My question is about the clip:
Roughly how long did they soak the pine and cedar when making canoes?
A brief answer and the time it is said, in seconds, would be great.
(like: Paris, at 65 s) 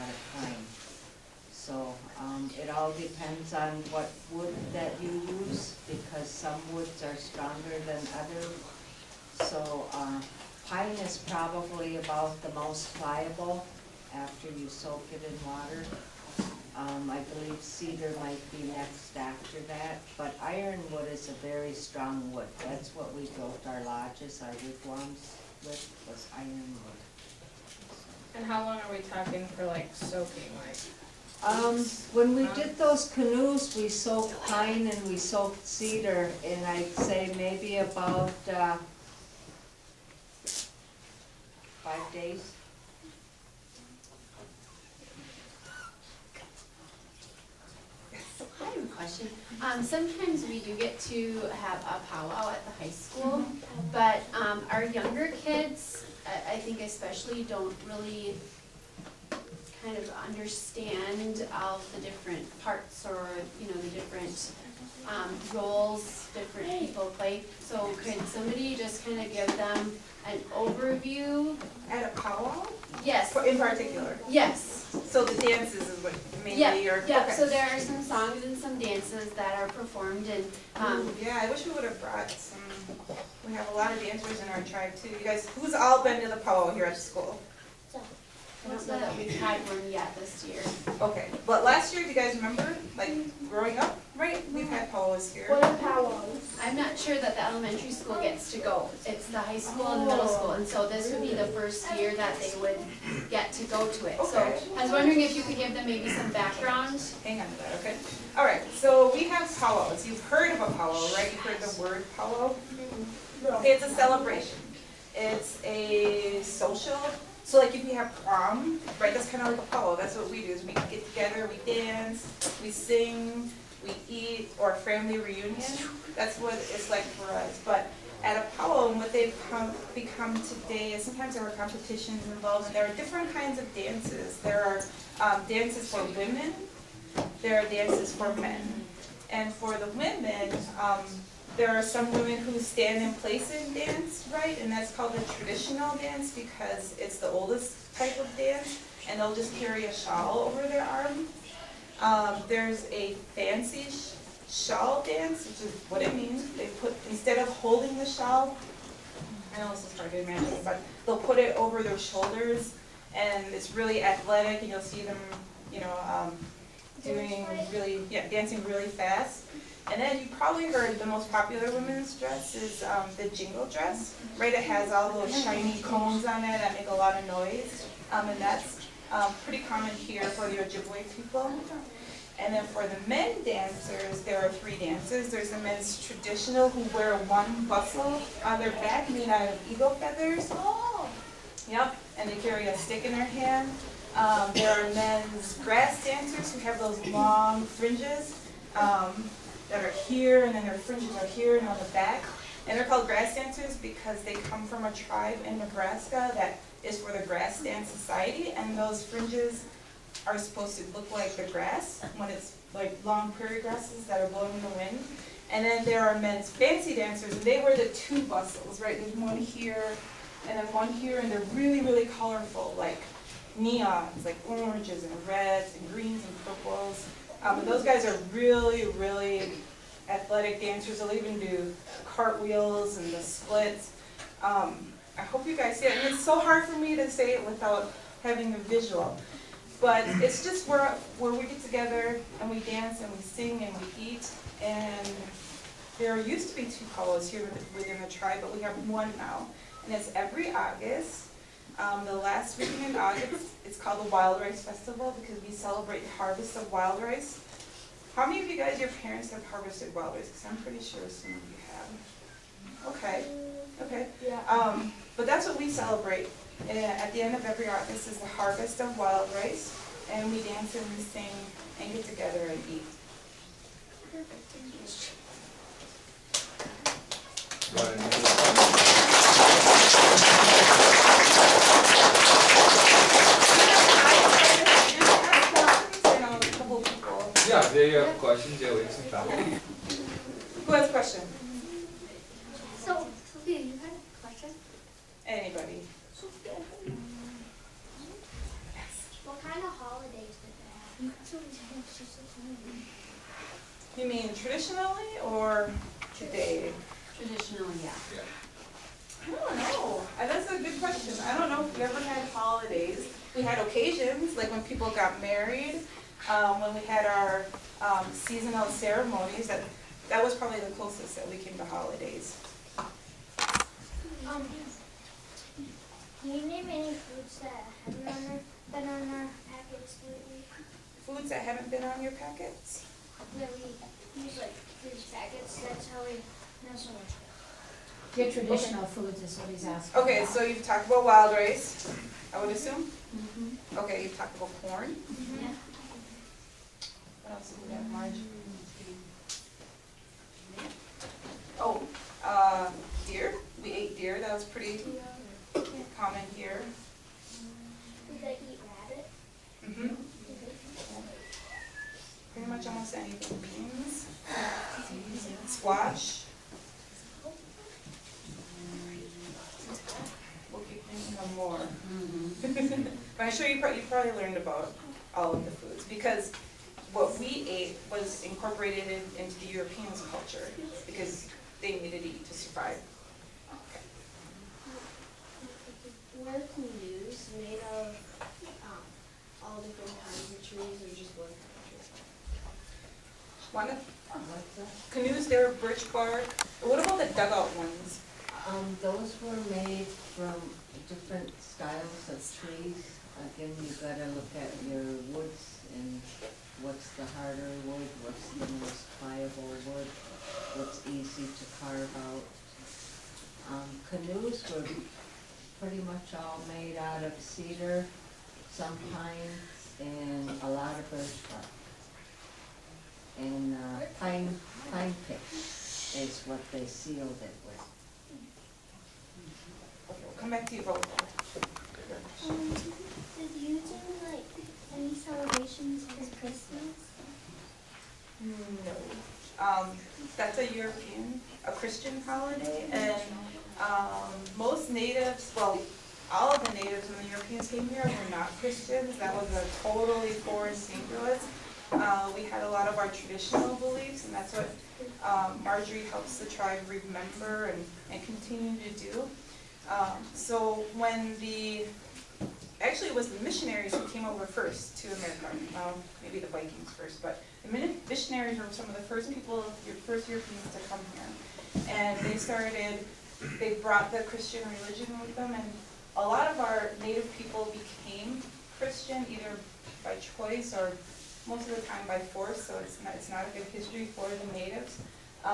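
5 days, at 41 s.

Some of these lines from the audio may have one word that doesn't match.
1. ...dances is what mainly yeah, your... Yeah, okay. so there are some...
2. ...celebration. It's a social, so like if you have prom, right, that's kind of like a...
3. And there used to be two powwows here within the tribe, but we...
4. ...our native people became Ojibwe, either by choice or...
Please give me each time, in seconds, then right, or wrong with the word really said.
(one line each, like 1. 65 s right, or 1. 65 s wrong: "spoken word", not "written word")
1. 75 s right
2. 113 s right
3. 244 s right
4. 476 s wrong: "Christian", not "Ojibwe".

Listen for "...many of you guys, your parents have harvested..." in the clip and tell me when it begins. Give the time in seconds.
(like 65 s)
258 s.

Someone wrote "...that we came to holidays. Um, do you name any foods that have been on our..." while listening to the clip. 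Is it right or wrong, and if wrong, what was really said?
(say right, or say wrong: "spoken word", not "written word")
right.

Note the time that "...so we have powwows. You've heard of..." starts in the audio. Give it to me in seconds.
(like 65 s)
108 s.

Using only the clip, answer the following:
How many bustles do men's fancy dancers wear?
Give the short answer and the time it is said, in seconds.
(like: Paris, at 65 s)
2, at 217 s.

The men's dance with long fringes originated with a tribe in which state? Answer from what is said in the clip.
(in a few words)
Nebraska.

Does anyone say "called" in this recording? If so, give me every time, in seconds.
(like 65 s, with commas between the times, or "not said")
144 s, 202 s, 253 s.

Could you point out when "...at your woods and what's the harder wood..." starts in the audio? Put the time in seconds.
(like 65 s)
404 s.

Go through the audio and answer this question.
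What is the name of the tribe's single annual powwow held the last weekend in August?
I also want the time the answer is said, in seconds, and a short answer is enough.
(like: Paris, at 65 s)
Wild Rice Festival, at 254 s.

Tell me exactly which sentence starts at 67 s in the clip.
So could somebody just kind of give them an overview?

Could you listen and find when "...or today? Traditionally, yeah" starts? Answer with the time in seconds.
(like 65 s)
305 s.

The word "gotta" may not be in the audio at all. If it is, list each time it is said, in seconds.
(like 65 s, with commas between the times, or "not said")
403 s.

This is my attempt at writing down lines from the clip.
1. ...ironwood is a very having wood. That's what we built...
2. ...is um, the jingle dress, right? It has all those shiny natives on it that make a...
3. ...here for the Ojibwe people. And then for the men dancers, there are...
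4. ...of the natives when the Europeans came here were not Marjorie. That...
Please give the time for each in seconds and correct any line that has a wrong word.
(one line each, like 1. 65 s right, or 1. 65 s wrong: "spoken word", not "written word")
1. 20 s wrong: "strong", not "having"
2. 172 s wrong: "cones", not "natives"
3. 179 s right
4. 446 s wrong: "Christians", not "Marjorie".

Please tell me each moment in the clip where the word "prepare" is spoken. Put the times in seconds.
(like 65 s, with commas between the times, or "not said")
not said.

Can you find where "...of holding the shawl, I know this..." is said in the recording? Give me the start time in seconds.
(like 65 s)
157 s.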